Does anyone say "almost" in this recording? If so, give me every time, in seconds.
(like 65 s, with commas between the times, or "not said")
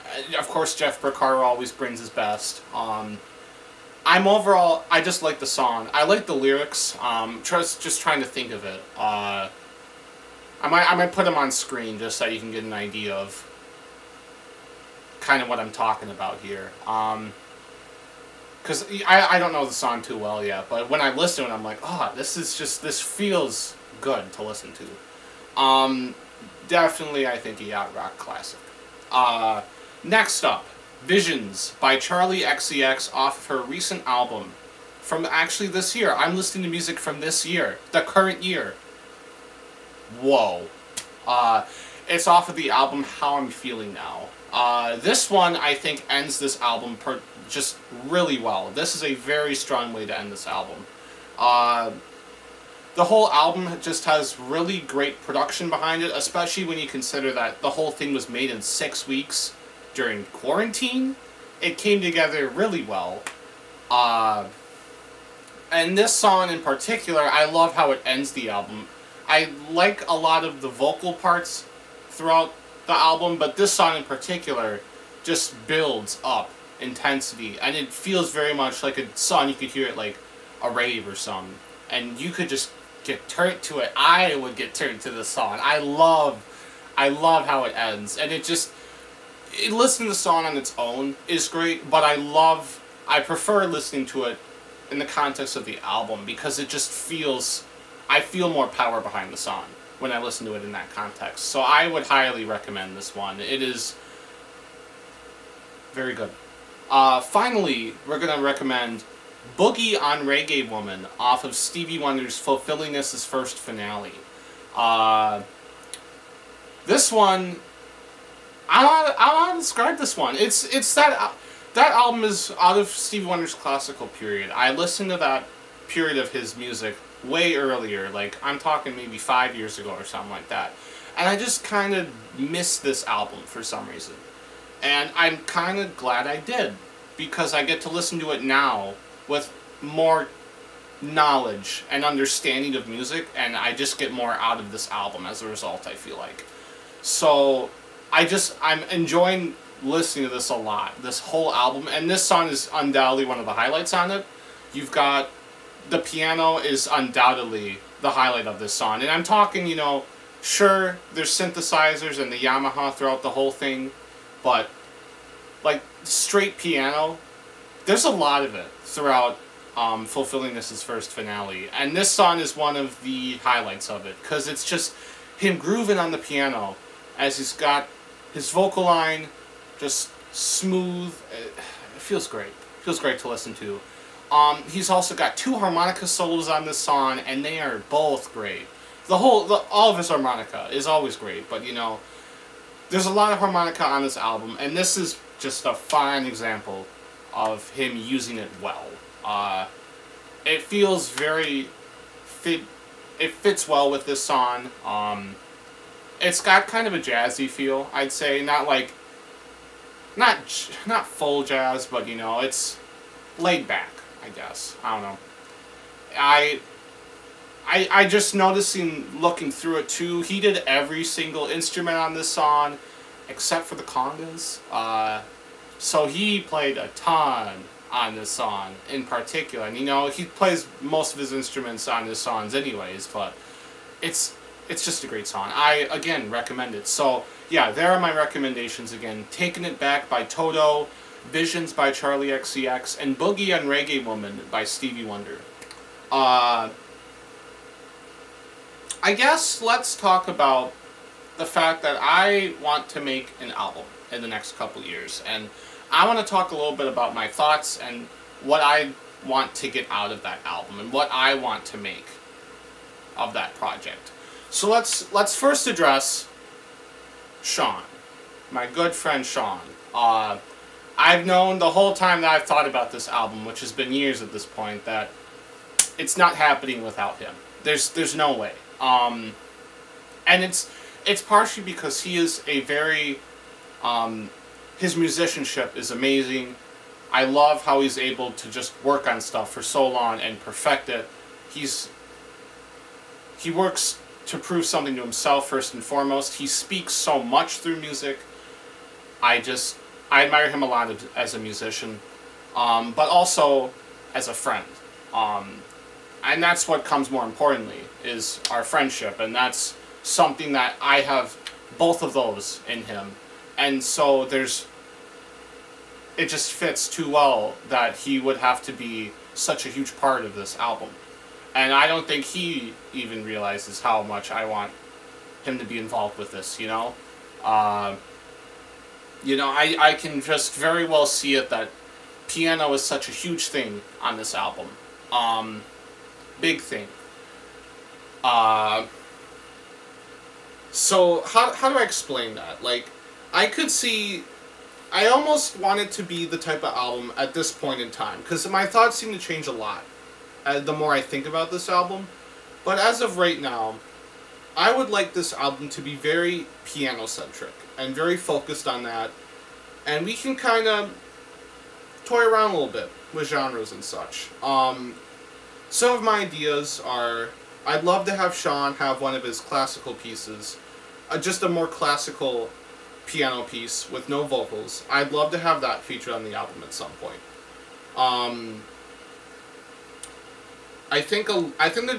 345 s.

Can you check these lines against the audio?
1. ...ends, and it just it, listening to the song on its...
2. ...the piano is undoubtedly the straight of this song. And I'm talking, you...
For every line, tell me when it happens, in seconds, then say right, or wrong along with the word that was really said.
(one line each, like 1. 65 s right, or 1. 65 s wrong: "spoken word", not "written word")
1. 87 s right
2. 155 s wrong: "highlight", not "straight".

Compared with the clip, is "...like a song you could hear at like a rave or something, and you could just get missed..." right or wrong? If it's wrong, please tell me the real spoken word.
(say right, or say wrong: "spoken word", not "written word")
wrong: "turned", not "missed".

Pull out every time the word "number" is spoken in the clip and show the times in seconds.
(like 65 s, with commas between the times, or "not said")
not said.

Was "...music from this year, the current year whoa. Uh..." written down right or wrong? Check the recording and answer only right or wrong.
right.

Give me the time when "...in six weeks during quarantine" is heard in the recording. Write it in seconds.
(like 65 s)
58 s.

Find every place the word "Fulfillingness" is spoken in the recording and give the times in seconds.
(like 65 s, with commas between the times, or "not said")
112 s, 170 s.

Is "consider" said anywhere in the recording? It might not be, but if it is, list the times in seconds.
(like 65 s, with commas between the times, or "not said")
56 s.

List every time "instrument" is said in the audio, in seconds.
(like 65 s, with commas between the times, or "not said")
221 s, 231 s.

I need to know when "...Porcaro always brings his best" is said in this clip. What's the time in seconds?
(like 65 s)
1 s.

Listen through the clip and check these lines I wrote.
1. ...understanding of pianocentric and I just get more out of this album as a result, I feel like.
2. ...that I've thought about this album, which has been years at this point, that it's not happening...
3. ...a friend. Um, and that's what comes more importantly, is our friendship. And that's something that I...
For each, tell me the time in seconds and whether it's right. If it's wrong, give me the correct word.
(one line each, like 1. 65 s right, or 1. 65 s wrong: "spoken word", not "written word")
1. 142 s wrong: "music", not "pianocentric"
2. 272 s right
3. 304 s right.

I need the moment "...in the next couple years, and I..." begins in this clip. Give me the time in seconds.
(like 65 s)
254 s.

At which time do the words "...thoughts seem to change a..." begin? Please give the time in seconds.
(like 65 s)
348 s.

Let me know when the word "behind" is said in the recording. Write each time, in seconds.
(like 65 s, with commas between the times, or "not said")
55 s, 98 s.